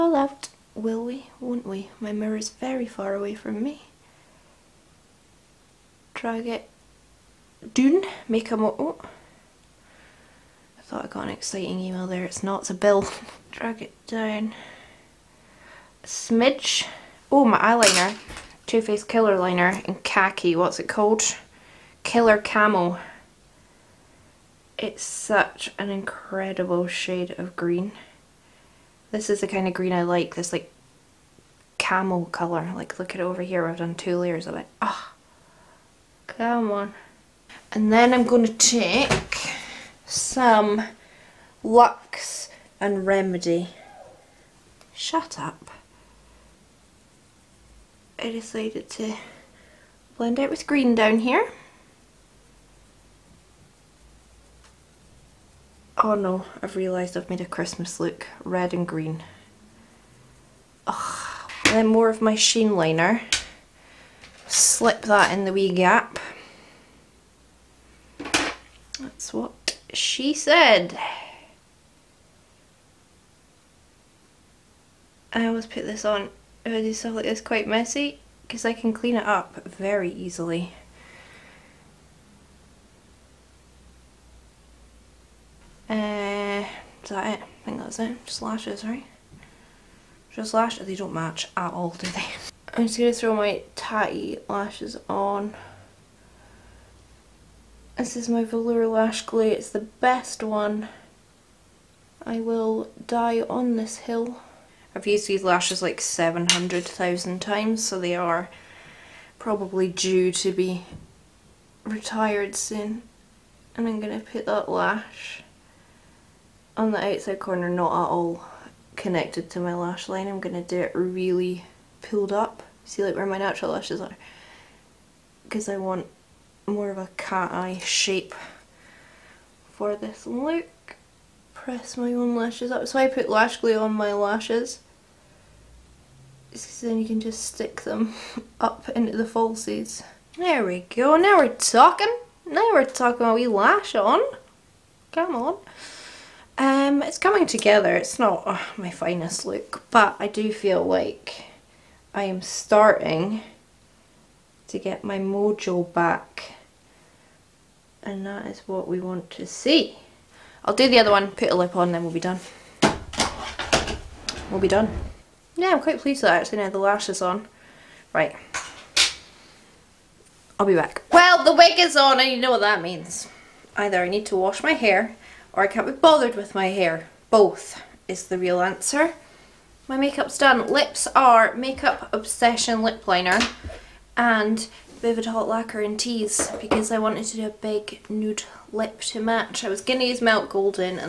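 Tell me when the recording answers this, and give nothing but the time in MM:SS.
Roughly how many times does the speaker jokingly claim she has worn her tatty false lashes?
01:46.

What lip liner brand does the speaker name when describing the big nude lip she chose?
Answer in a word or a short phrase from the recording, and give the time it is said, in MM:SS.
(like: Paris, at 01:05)
Makeup Obsession, at 03:01.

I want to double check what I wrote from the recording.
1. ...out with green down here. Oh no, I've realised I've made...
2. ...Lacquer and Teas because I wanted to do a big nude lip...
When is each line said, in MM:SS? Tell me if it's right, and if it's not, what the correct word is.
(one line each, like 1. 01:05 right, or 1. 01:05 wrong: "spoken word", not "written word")
1. 00:50 right
2. 03:05 right.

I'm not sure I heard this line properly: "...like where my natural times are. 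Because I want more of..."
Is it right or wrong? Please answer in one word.
wrong.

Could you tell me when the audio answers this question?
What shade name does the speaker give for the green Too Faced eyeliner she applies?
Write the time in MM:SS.
00:22.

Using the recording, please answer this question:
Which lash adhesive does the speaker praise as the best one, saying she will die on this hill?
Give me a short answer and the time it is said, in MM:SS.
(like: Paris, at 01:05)
Velour Lash Glue, at 01:38.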